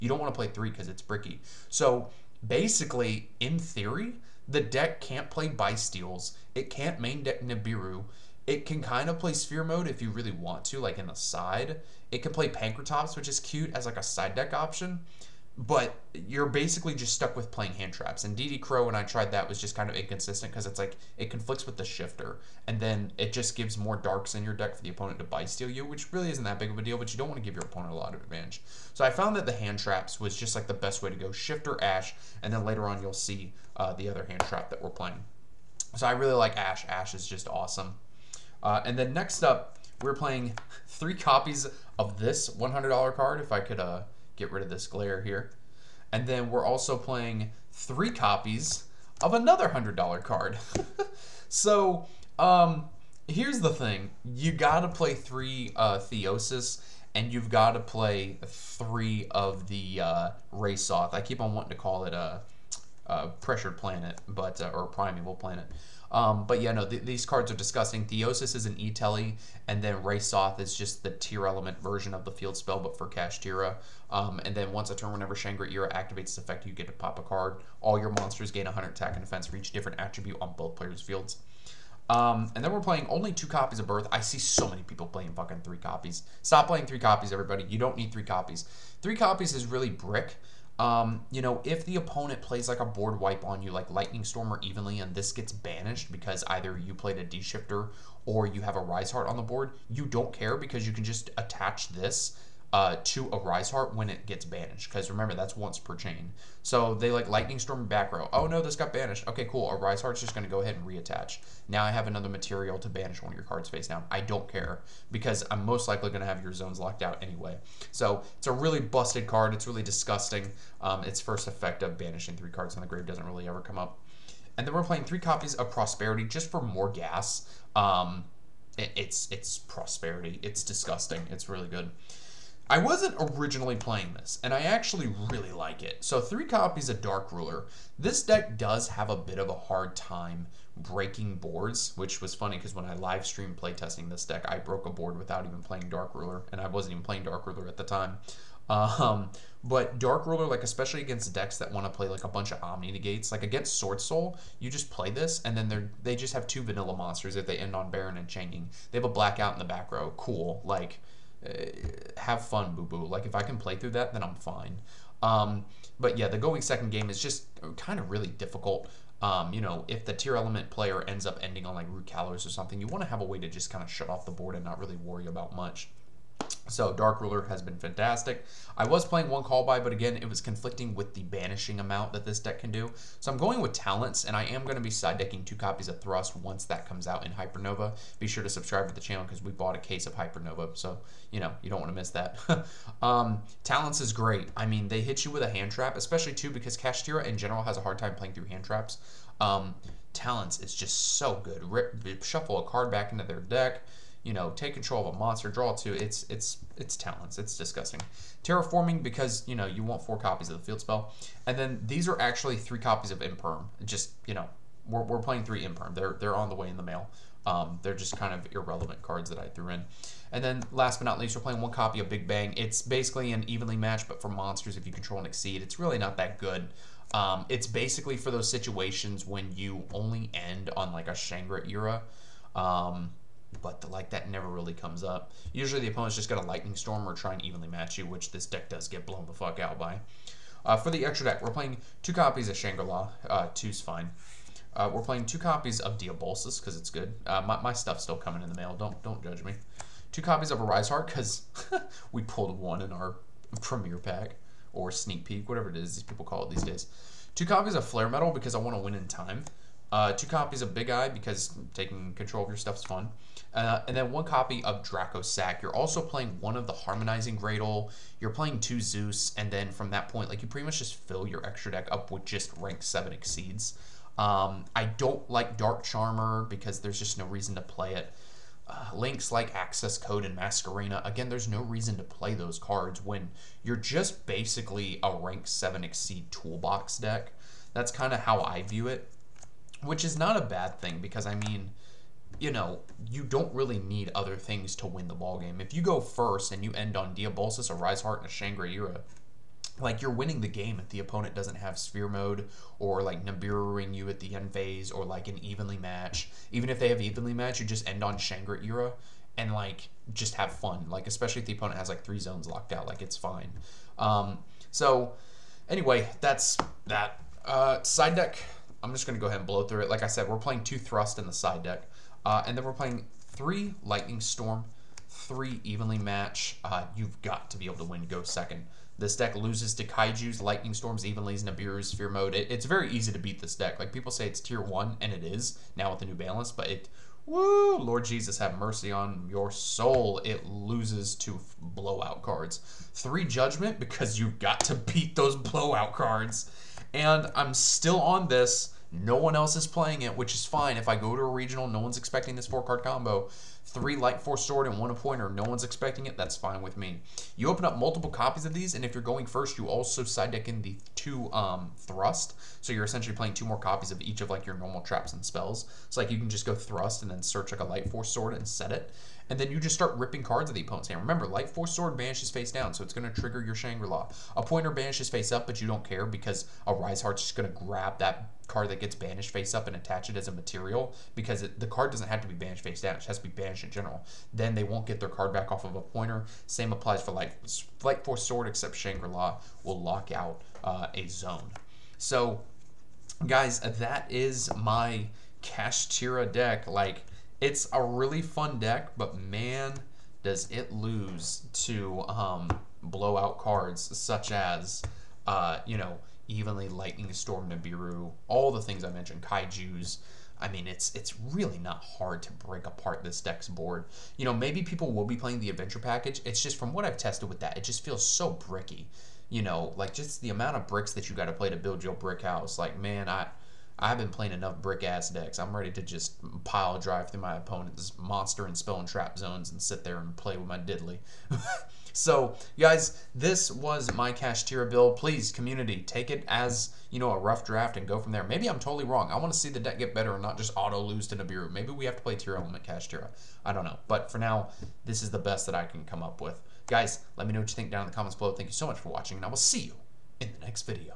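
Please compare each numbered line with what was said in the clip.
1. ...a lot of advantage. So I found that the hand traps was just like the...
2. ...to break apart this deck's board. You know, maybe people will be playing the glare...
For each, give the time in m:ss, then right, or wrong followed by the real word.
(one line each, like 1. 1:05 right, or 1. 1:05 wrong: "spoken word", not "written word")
1. 0:27 right
2. 6:52 wrong: "adventure", not "glare".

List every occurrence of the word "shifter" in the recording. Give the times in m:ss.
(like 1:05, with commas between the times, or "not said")
0:21, 0:31, 1:37.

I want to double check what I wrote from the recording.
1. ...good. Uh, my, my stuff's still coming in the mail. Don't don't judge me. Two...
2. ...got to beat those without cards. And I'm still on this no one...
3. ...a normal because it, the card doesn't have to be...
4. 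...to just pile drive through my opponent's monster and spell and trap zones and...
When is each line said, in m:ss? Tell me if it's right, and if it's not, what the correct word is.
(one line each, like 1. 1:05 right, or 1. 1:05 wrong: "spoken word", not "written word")
1. 4:06 right
2. 5:44 wrong: "blowout", not "without"
3. 6:20 wrong: "material", not "normal"
4. 7:05 right.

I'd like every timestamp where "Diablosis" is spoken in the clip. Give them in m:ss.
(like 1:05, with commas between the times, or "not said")
4:05, 4:57.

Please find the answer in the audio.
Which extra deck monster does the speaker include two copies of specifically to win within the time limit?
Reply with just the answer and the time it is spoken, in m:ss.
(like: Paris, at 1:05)
Flare Metal, at 4:17.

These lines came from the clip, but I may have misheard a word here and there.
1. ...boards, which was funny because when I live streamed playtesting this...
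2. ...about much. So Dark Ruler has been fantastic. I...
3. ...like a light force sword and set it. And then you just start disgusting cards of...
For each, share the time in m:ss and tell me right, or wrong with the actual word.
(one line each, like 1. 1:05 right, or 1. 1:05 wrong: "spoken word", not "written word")
1. 2:21 right
2. 2:55 right
3. 6:07 wrong: "ripping", not "disgusting".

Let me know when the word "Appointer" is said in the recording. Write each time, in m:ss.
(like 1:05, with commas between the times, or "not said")
5:54, 6:14, 6:25.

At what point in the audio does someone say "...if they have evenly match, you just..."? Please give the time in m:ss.
5:06.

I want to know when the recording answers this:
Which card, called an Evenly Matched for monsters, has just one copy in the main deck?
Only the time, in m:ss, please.
3:42.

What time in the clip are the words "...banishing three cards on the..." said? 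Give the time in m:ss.
2:01.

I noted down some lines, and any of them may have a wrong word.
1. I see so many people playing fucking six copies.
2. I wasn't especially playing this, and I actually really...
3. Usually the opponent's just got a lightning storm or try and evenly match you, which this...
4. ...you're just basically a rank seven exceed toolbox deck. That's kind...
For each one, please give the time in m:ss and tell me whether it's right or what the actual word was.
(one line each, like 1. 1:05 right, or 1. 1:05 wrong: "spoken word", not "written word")
1. 1:24 wrong: "three", not "six"
2. 2:12 wrong: "originally", not "especially"
3. 3:55 right
4. 4:43 right.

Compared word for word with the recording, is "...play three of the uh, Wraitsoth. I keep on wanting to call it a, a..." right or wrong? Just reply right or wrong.
right.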